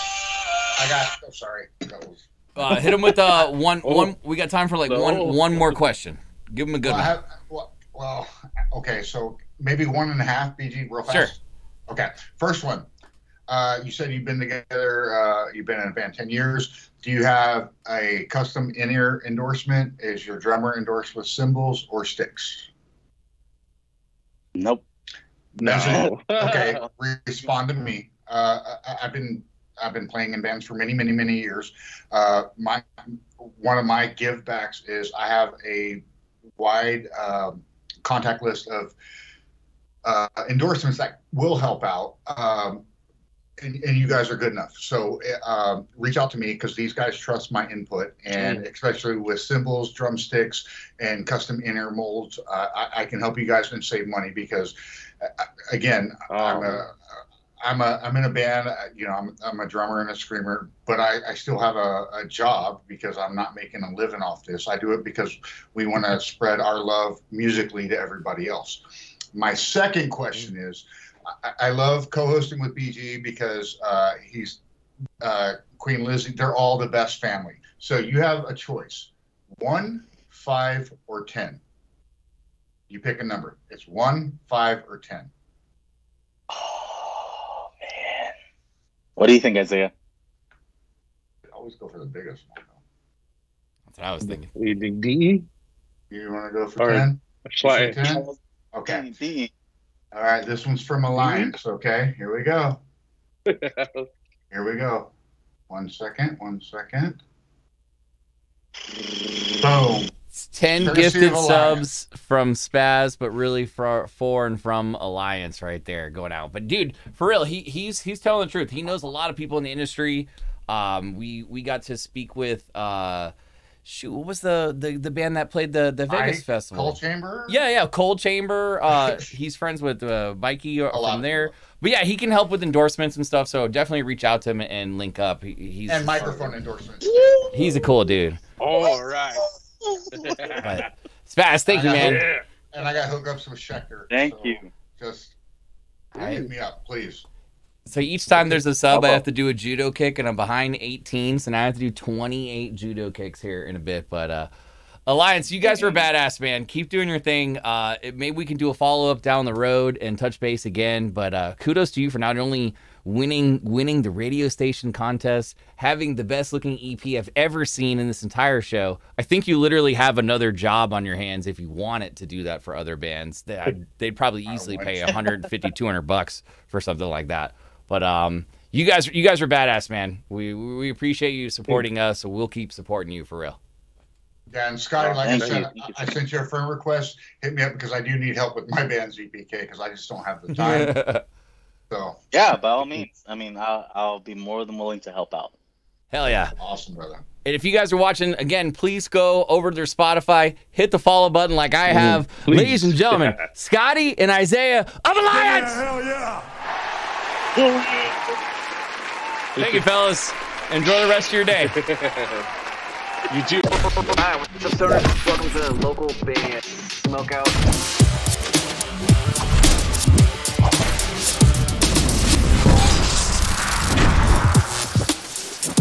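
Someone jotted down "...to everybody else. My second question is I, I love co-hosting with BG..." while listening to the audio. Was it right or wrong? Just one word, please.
right.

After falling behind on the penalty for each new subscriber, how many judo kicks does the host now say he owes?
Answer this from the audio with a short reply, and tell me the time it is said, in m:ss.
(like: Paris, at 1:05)
28, at 2:31.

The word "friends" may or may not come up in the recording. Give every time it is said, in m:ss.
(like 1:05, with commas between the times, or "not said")
2:09, 3:06.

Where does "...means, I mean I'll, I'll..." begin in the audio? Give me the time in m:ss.
3:12.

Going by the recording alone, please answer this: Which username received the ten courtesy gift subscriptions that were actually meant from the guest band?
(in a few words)
Spaz.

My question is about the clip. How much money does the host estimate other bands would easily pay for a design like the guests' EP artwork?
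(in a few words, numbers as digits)
150 to 200 dollars.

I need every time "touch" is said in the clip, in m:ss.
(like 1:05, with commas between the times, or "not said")
2:40.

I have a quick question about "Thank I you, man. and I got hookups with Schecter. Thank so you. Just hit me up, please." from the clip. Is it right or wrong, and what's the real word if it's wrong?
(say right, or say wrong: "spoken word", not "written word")
right.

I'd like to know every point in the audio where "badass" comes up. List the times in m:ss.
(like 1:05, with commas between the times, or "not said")
2:35, 2:59.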